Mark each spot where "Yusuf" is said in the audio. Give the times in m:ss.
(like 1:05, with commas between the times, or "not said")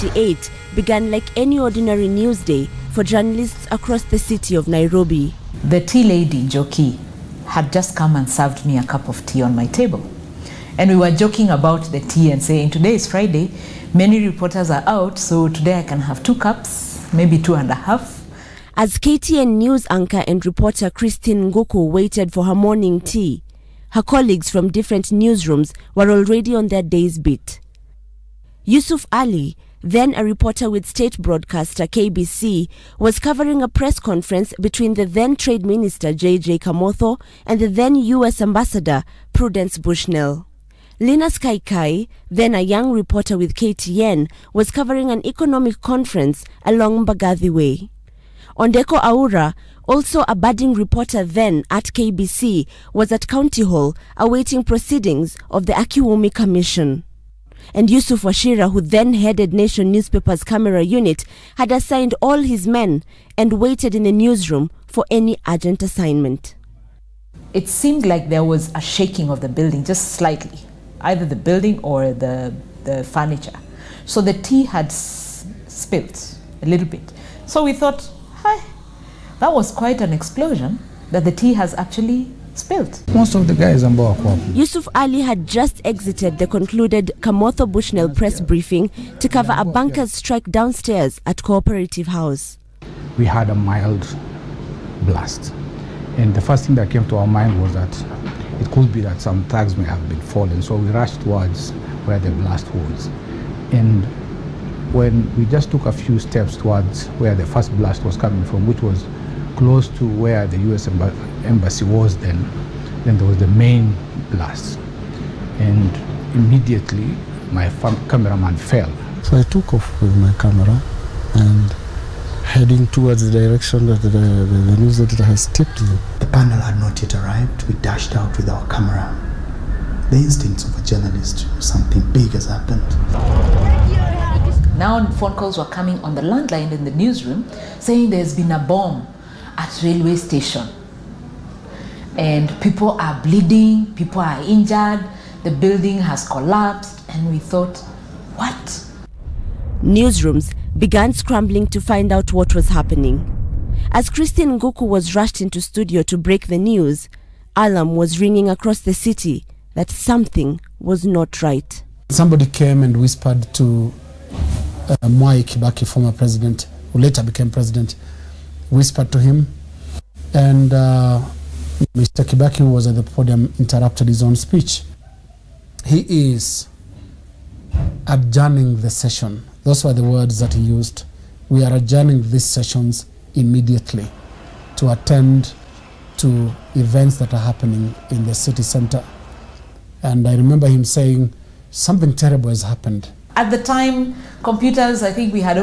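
0:28, 0:57, 1:24.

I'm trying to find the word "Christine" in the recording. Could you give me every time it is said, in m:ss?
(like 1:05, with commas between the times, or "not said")
0:20, 2:34.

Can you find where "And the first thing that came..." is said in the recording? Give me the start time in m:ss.
1:36.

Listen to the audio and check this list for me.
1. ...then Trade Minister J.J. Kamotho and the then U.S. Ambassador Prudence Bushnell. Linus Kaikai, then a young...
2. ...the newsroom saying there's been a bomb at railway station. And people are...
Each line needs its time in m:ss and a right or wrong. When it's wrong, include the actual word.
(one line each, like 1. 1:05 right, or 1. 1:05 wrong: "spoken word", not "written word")
1. 0:35 right
2. 2:16 right.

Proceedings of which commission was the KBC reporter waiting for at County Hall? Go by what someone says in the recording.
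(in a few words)
Akiwumi Commission.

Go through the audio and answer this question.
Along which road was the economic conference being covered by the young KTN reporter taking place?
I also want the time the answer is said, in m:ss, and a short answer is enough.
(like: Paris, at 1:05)
Mbagathi Way, at 0:47.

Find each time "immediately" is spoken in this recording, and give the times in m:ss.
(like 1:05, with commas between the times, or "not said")
1:56, 3:03.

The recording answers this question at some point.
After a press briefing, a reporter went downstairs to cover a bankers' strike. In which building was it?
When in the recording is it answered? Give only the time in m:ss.
1:31.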